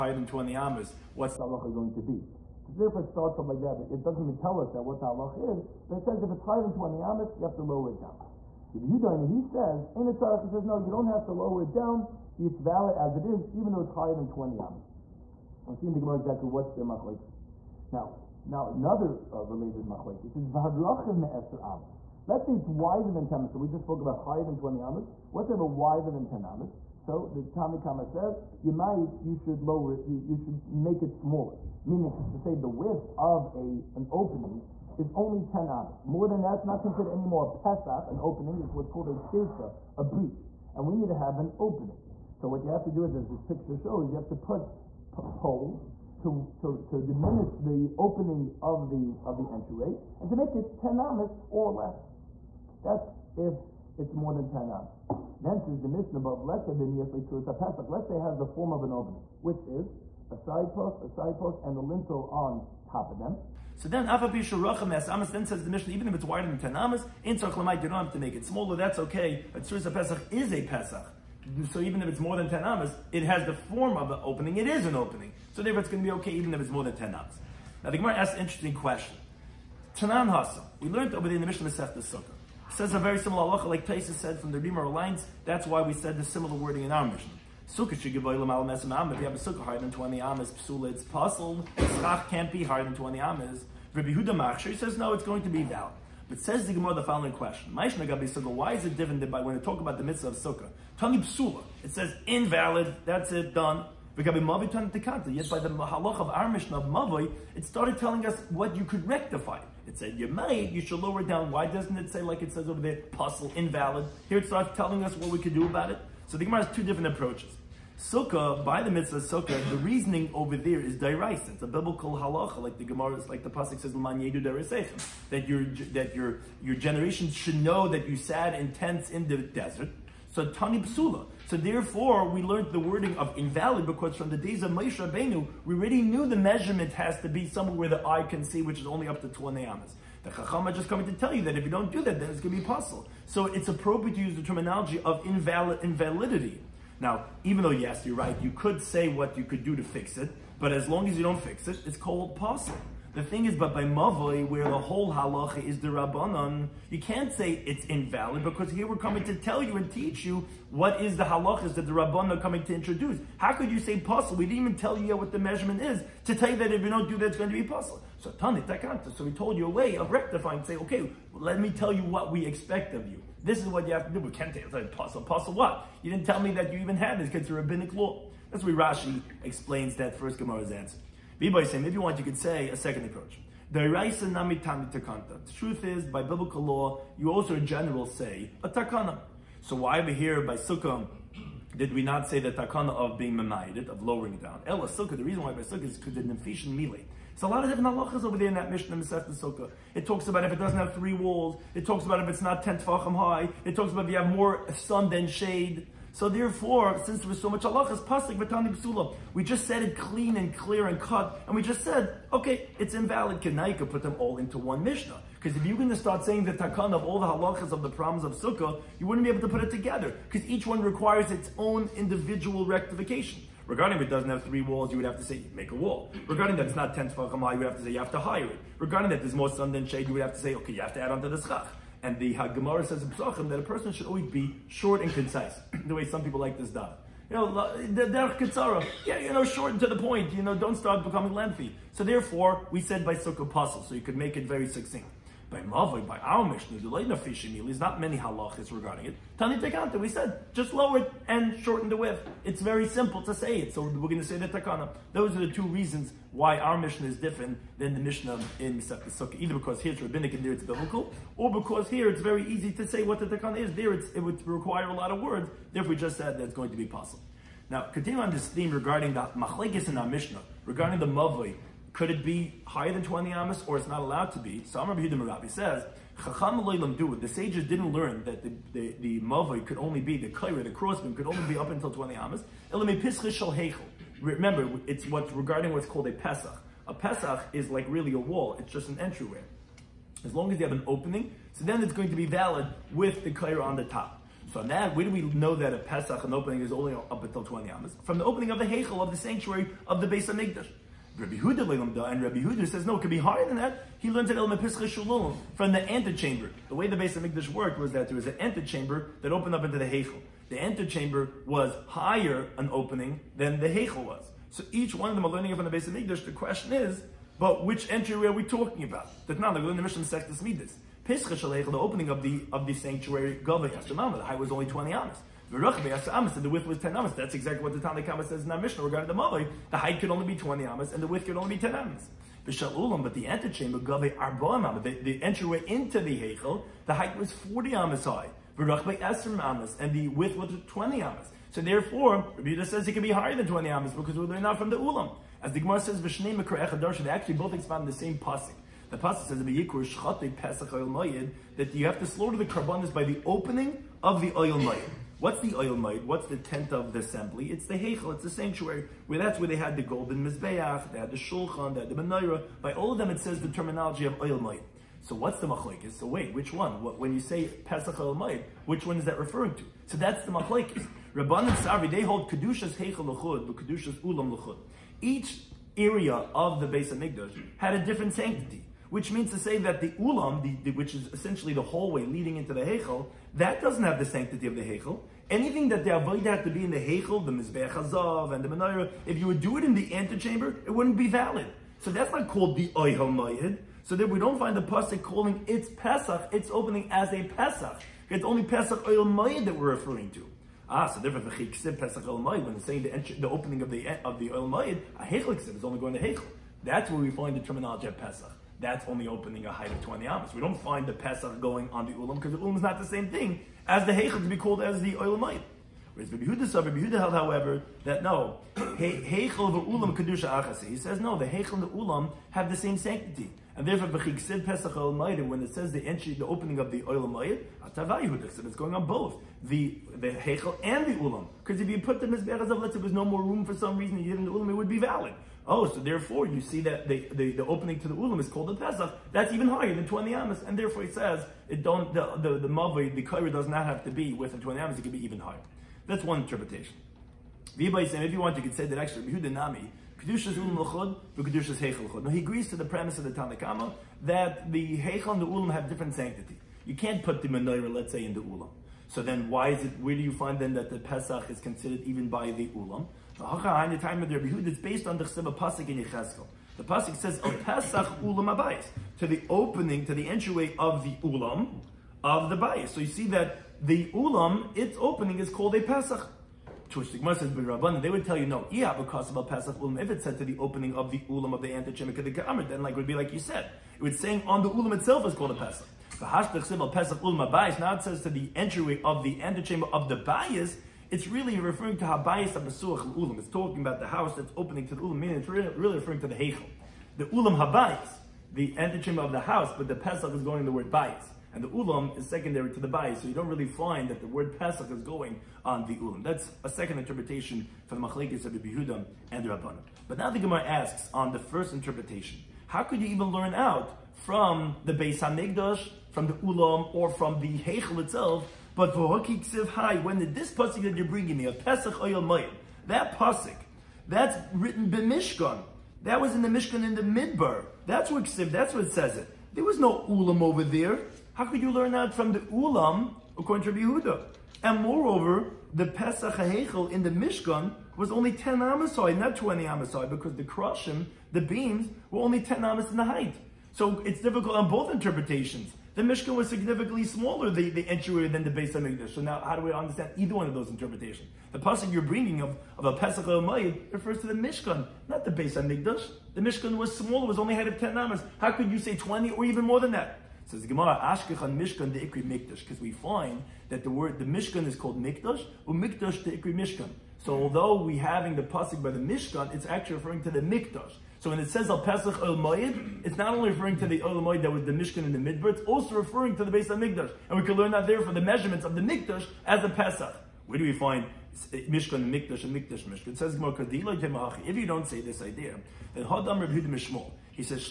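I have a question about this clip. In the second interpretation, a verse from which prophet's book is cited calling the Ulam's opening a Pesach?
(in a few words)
Yecheskel.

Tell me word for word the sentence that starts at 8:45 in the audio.
That was in the Mishkan in the Midbar.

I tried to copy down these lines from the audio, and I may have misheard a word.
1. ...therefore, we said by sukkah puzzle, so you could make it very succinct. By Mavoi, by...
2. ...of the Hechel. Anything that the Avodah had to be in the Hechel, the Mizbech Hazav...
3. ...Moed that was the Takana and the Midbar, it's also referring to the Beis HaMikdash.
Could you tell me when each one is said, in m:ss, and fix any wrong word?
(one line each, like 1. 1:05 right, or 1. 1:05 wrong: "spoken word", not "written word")
1. 4:02 right
2. 6:24 right
3. 9:34 wrong: "Mishkan", not "Takana".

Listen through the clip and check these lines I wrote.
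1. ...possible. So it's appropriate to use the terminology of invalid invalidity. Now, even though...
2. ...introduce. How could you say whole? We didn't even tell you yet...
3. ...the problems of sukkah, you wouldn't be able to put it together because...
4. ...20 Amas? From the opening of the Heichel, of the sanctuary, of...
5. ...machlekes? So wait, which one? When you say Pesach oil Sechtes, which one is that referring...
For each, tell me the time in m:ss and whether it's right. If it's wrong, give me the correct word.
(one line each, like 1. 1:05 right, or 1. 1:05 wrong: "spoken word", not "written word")
1. 2:22 right
2. 2:42 wrong: "puzzle", not "whole"
3. 3:37 right
4. 4:57 right
5. 6:05 wrong: "Maid", not "Sechtes".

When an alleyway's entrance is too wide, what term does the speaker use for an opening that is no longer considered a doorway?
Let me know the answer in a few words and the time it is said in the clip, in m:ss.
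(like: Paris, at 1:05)
pirza, at 0:39.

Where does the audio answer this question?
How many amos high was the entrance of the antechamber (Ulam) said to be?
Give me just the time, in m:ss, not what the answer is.
5:37.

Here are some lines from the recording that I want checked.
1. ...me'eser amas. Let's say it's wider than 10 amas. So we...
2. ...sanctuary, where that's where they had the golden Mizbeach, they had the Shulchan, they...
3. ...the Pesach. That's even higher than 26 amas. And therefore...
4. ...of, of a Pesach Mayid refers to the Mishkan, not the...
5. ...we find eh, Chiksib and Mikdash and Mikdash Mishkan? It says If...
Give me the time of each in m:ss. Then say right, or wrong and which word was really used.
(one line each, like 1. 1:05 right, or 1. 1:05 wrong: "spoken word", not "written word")
1. 0:21 right
2. 5:58 right
3. 7:18 wrong: "20", not "26"
4. 9:12 right
5. 9:40 wrong: "Mishkan", not "Chiksib".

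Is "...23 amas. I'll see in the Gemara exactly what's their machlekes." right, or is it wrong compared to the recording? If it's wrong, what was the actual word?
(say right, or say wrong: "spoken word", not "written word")
wrong: "20", not "23".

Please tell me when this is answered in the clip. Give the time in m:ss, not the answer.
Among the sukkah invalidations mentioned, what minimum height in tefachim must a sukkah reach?
3:22.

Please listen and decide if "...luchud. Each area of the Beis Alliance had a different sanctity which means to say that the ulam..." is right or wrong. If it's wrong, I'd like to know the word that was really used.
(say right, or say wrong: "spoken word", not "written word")
wrong: "HaMikdash", not "Alliance".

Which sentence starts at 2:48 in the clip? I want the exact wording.
So, Tanit, So, we told you a way of rectifying, say, okay, let me tell you what we expect of you.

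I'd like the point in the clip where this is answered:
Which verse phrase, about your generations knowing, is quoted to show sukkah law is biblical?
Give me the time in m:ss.
2:03.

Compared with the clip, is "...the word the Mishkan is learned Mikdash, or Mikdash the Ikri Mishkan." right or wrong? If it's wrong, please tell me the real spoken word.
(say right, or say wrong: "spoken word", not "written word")
wrong: "called", not "learned".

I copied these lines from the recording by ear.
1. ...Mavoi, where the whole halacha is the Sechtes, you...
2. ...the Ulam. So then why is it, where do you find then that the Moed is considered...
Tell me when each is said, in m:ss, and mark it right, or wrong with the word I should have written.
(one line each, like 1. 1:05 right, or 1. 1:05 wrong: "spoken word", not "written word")
1. 2:33 wrong: "Rabbanon", not "Sechtes"
2. 7:38 wrong: "Pesach", not "Moed".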